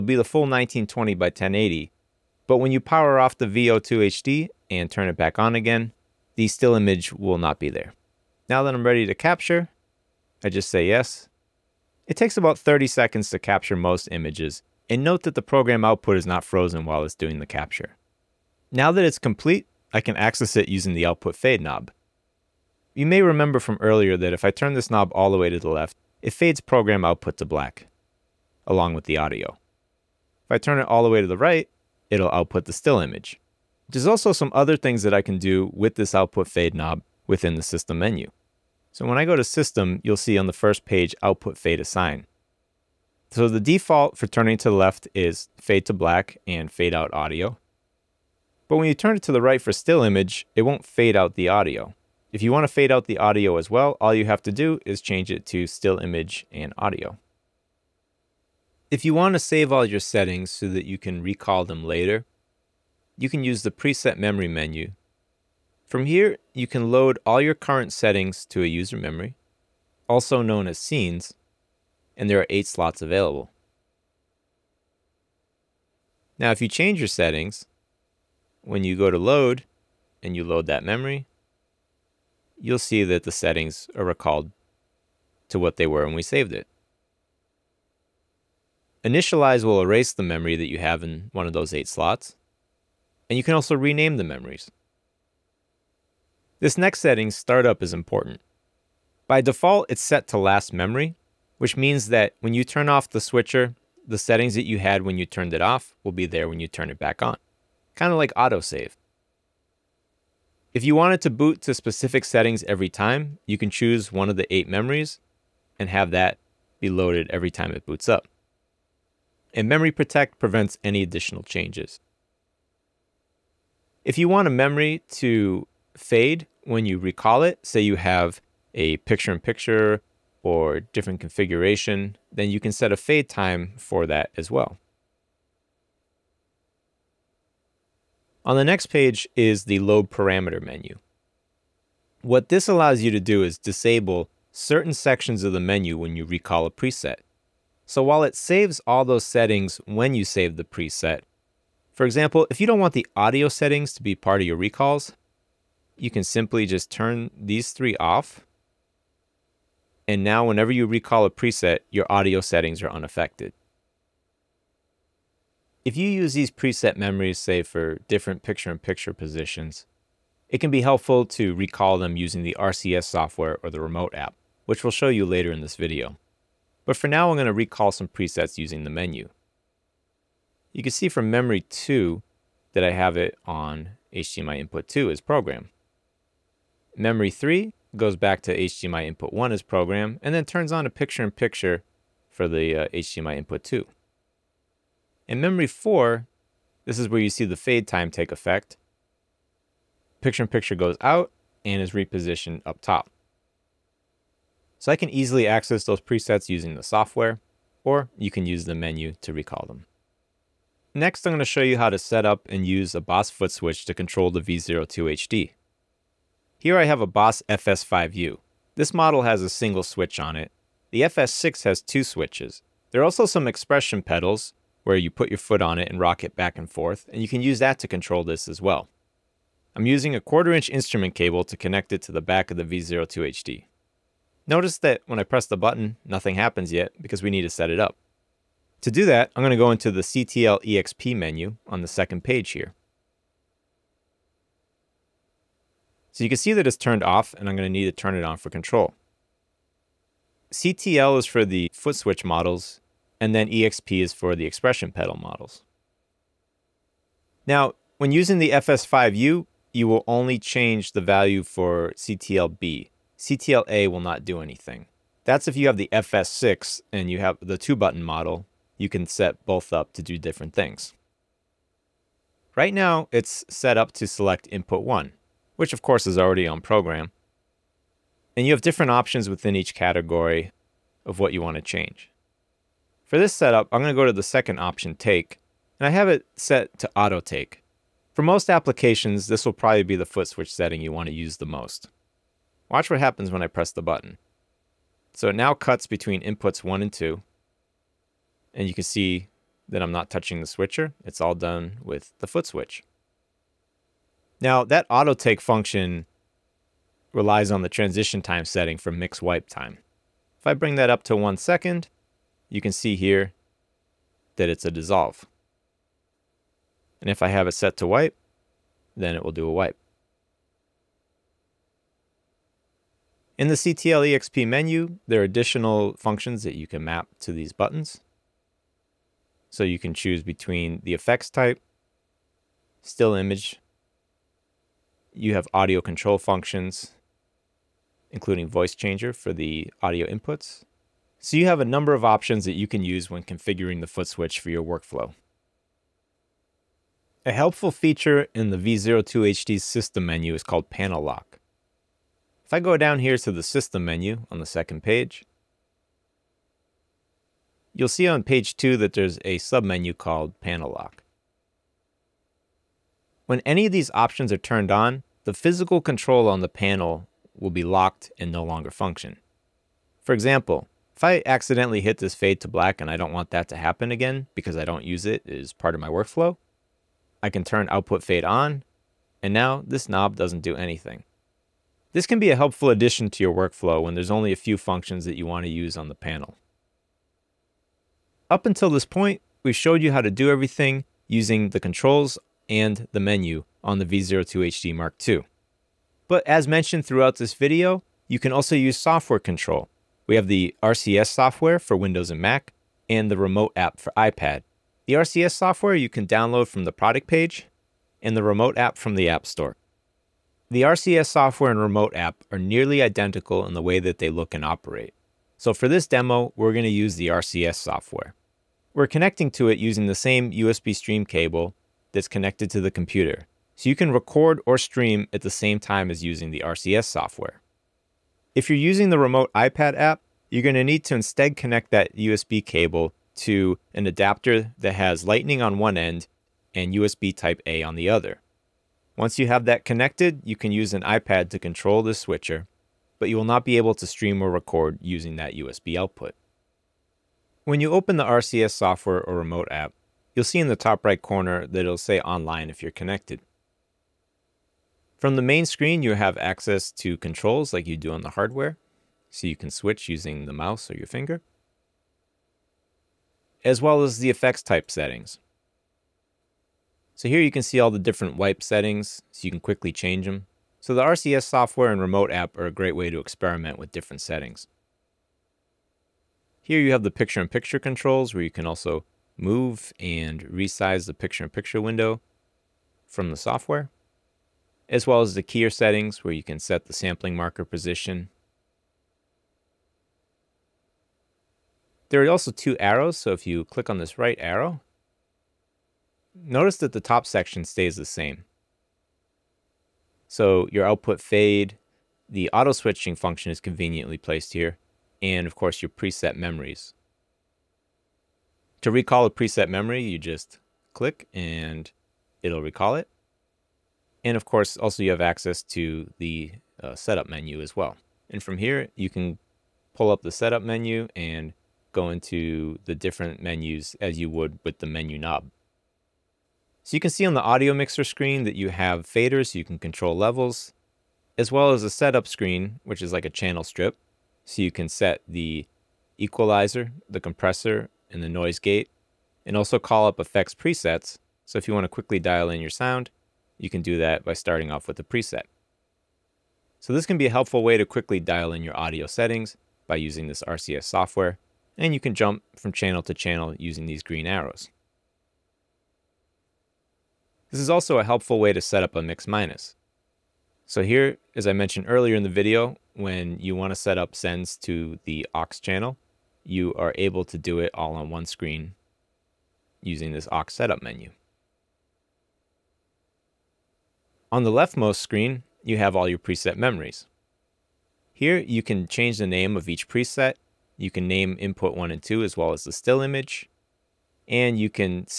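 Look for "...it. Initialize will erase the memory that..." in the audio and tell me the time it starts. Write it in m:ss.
1:26.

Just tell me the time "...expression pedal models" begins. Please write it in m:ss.
4:14.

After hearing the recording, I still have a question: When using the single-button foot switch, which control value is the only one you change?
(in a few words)
CTL B.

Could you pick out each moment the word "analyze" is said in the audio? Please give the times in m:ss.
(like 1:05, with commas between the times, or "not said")
not said.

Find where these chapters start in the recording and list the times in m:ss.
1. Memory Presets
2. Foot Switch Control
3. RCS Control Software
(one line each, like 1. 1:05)
1. 0:56
2. 3:27
3. 6:25.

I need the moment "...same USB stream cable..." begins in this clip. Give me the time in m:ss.
6:59.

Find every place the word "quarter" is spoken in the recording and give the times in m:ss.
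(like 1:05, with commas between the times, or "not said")
3:50.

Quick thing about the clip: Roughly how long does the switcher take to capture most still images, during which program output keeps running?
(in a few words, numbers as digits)
30 seconds.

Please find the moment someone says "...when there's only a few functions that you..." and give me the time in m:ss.
6:23.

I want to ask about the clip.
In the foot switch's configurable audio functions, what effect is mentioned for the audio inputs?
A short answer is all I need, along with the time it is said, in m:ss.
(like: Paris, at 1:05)
Voice changer, at 5:38.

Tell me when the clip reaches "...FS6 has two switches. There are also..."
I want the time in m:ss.
3:41.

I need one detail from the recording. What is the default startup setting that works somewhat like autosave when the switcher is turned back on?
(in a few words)
Last memory.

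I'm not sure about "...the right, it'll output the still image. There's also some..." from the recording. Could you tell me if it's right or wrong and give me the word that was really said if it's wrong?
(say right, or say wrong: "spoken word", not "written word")
right.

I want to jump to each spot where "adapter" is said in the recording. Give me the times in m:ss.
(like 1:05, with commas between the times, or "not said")
7:13.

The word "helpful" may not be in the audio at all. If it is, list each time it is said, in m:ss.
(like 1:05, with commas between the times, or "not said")
2:50, 5:47, 6:22, 9:07, 9:17.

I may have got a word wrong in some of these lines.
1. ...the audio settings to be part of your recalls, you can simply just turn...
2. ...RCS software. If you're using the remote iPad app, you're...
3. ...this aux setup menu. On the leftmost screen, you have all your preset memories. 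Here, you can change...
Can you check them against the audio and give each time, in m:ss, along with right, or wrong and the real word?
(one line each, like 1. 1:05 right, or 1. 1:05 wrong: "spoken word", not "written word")
1. 2:32 right
2. 7:06 right
3. 9:29 right.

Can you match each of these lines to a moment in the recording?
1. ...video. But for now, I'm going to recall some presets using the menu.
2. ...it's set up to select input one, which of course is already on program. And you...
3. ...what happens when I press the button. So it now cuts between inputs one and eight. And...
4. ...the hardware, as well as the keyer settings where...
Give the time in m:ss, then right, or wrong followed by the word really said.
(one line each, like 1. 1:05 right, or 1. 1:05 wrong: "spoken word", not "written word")
1. 2:55 right
2. 4:33 right
3. 4:52 wrong: "two", not "eight"
4. 8:03 wrong: "software", not "hardware".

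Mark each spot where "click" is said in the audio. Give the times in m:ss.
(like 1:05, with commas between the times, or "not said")
8:13, 8:30.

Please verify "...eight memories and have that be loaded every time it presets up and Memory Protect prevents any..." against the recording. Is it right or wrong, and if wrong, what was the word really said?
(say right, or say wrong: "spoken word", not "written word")
wrong: "boots", not "presets".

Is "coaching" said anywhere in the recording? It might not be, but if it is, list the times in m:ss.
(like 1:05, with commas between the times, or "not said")
not said.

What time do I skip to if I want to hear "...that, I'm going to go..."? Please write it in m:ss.
3:59.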